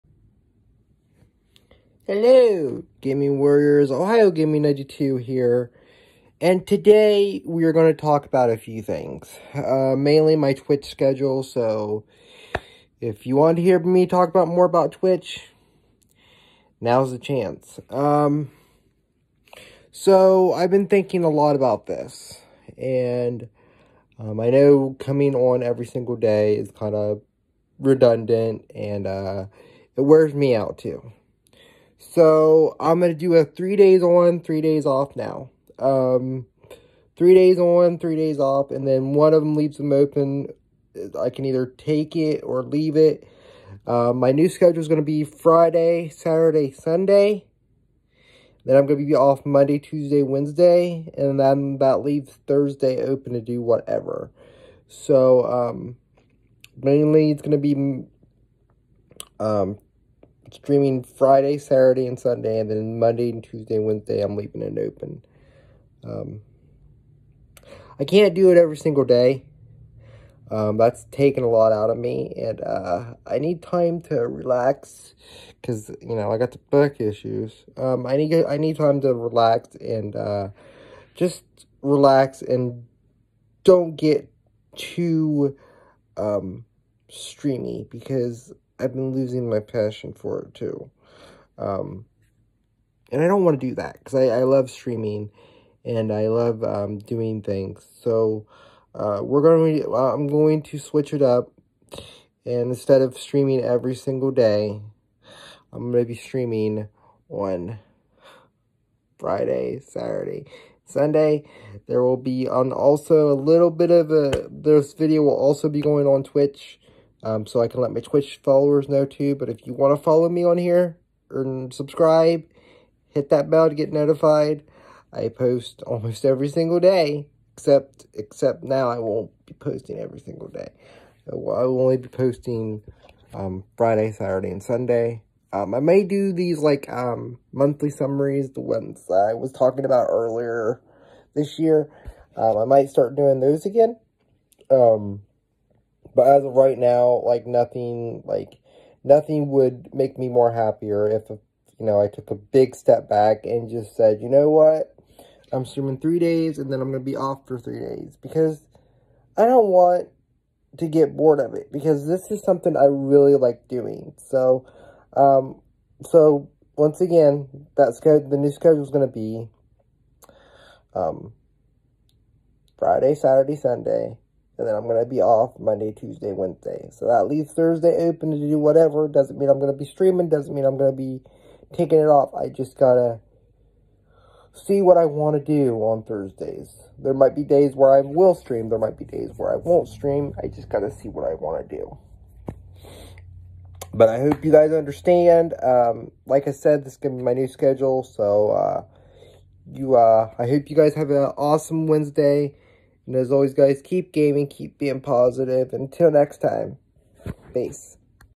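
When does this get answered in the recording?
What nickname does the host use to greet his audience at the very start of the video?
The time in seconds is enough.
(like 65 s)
3 s.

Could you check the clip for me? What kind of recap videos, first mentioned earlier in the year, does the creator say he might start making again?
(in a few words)
Monthly summaries.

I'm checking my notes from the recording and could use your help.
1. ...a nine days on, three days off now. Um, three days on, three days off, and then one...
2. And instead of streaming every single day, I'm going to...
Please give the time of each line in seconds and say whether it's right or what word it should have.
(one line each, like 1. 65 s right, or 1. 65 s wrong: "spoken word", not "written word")
1. 33 s wrong: "three", not "nine"
2. 102 s right.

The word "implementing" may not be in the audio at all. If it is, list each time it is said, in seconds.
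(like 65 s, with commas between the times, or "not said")
not said.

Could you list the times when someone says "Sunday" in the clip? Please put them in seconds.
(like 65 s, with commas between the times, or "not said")
46 s, 62 s, 110 s, 134 s, 173 s.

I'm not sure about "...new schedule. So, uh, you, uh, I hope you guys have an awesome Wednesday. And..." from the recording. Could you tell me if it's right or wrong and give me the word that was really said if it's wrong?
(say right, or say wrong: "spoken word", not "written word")
right.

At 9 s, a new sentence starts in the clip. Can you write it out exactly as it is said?
Uh, mainly my Twitch schedule, so if you want to hear me talk about more about Twitch, now's the chance.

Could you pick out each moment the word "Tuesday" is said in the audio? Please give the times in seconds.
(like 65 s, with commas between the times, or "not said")
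49 s, 63 s, 175 s.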